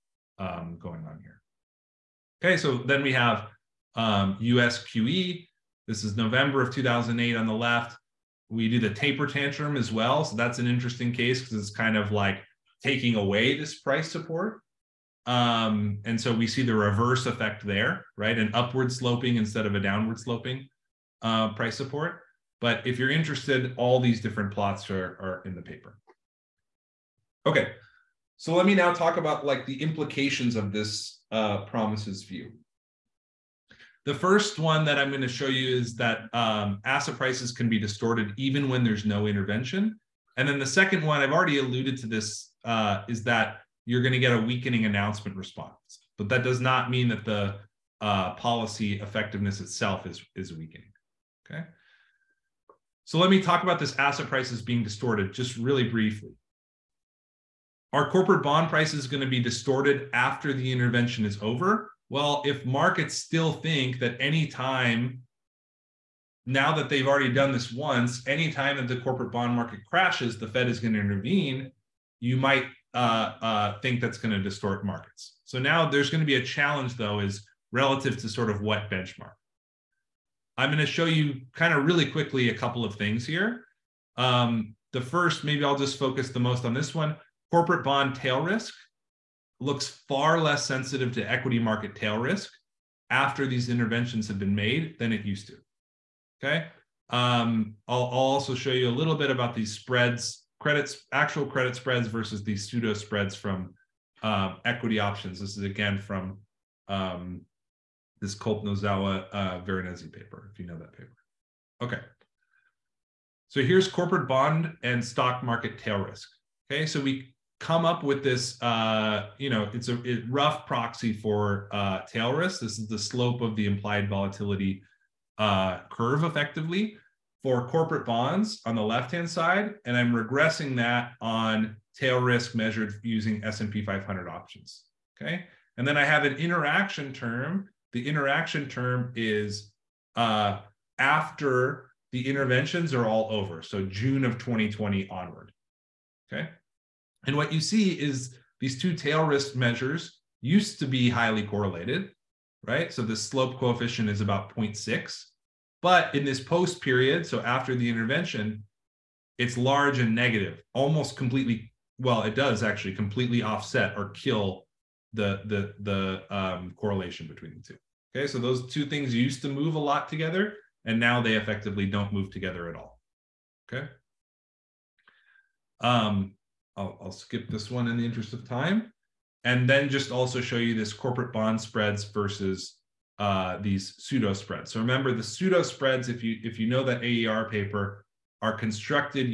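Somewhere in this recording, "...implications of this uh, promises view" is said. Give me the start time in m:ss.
0:29.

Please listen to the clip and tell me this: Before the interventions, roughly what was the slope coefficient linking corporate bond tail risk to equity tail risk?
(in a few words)
0.6.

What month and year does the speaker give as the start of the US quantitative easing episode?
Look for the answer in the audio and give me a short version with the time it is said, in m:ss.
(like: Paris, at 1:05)
November 2008, at 0:06.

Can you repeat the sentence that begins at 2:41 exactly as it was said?
Well, it does actually completely offset or kill the the the um, correlation between the two.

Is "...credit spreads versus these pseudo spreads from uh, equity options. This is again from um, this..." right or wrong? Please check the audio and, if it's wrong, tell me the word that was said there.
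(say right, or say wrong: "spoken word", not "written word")
right.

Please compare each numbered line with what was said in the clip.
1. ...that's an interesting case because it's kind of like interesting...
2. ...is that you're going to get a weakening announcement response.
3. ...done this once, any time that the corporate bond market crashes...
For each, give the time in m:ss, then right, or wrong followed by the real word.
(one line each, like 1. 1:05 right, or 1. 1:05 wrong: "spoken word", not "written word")
1. 0:10 wrong: "taking", not "interesting"
2. 0:43 right
3. 1:07 right.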